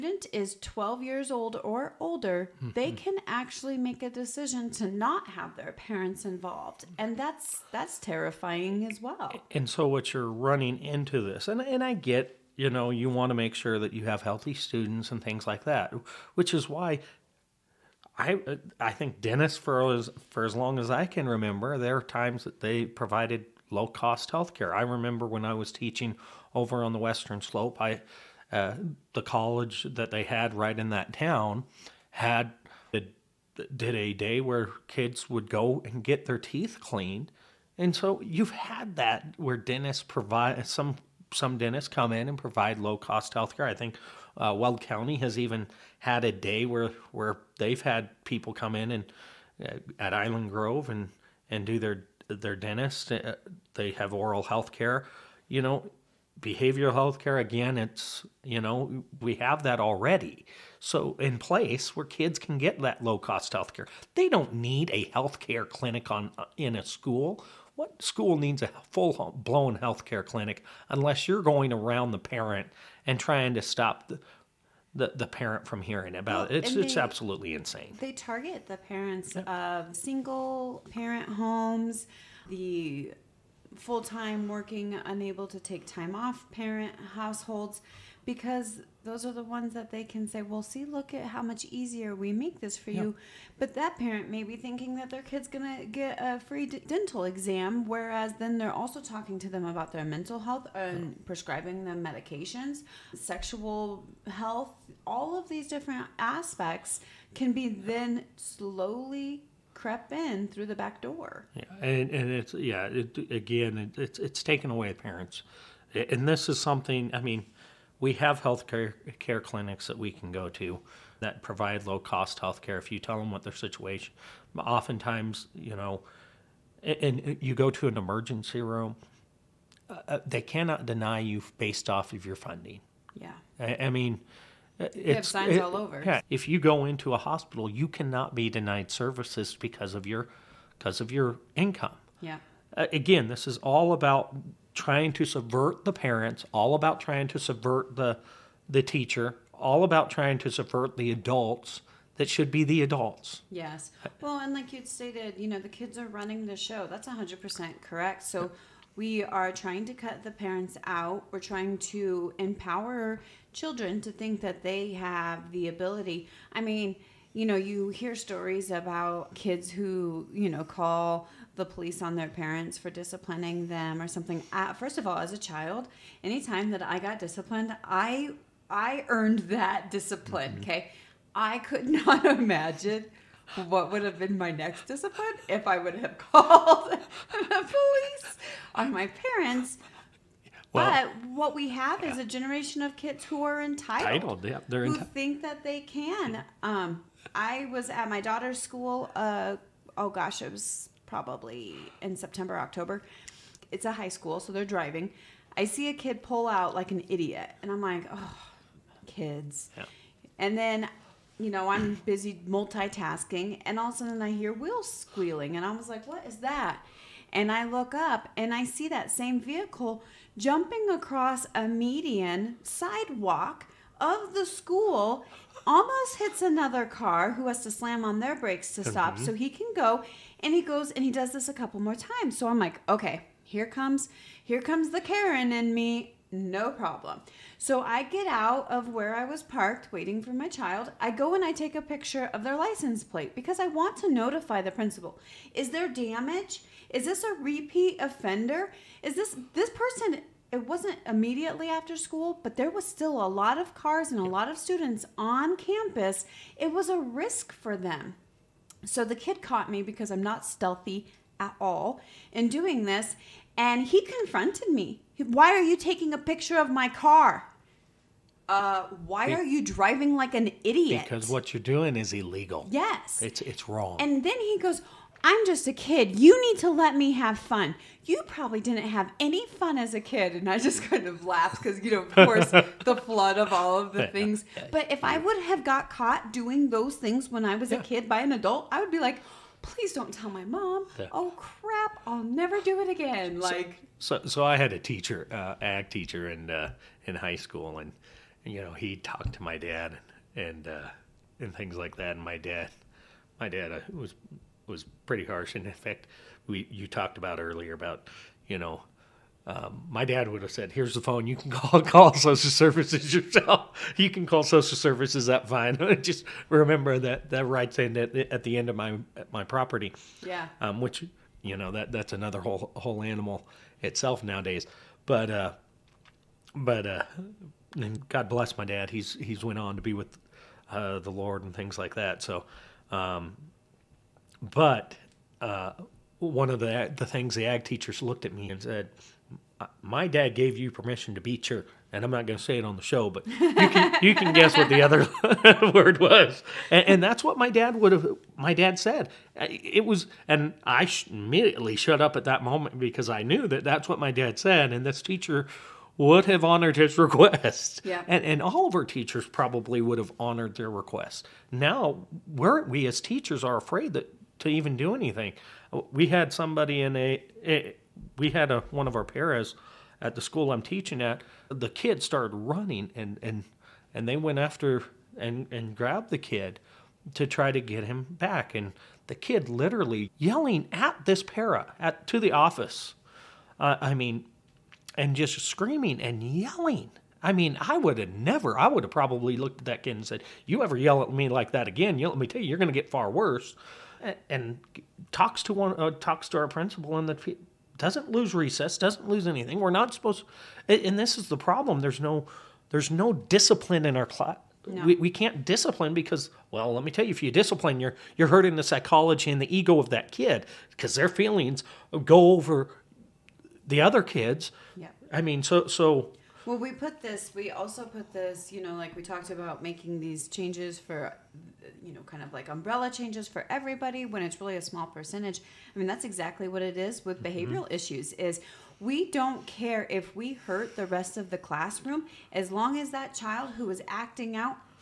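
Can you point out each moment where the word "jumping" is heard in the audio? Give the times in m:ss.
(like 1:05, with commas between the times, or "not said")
3:40.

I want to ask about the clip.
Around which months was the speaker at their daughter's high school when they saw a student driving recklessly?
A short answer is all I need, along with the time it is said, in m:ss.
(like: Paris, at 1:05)
September, October, at 3:22.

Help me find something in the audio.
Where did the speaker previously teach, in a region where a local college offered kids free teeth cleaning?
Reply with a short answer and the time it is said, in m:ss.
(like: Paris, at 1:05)
Western Slope, at 0:26.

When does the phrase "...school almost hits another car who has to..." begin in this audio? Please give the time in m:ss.
3:44.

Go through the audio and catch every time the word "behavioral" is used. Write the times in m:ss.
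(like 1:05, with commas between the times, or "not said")
0:56, 7:07.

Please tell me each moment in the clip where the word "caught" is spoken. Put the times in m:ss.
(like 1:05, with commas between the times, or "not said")
4:19, 4:45.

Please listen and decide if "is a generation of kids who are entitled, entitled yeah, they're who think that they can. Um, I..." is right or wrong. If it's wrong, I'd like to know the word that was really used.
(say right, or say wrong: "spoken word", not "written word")
right.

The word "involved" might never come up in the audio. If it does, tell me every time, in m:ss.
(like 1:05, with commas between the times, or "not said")
0:06.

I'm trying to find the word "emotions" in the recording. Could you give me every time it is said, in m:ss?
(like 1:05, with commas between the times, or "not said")
not said.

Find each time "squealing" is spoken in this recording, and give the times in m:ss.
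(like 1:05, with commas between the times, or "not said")
3:34.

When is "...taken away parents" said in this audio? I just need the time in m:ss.
1:54.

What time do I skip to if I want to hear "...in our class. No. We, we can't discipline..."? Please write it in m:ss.
6:43.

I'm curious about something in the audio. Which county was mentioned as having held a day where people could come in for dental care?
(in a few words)
Weld County.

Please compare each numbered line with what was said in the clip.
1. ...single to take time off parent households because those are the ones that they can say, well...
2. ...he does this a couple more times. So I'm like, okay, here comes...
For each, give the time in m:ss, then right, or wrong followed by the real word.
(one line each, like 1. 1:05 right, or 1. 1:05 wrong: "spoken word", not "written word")
1. 1:25 wrong: "unable", not "single"
2. 3:51 right.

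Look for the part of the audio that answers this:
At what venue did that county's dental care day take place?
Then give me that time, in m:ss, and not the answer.
0:50.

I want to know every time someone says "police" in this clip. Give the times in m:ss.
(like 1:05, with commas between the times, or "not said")
2:51, 3:07.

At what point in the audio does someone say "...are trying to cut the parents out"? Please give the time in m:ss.
2:39.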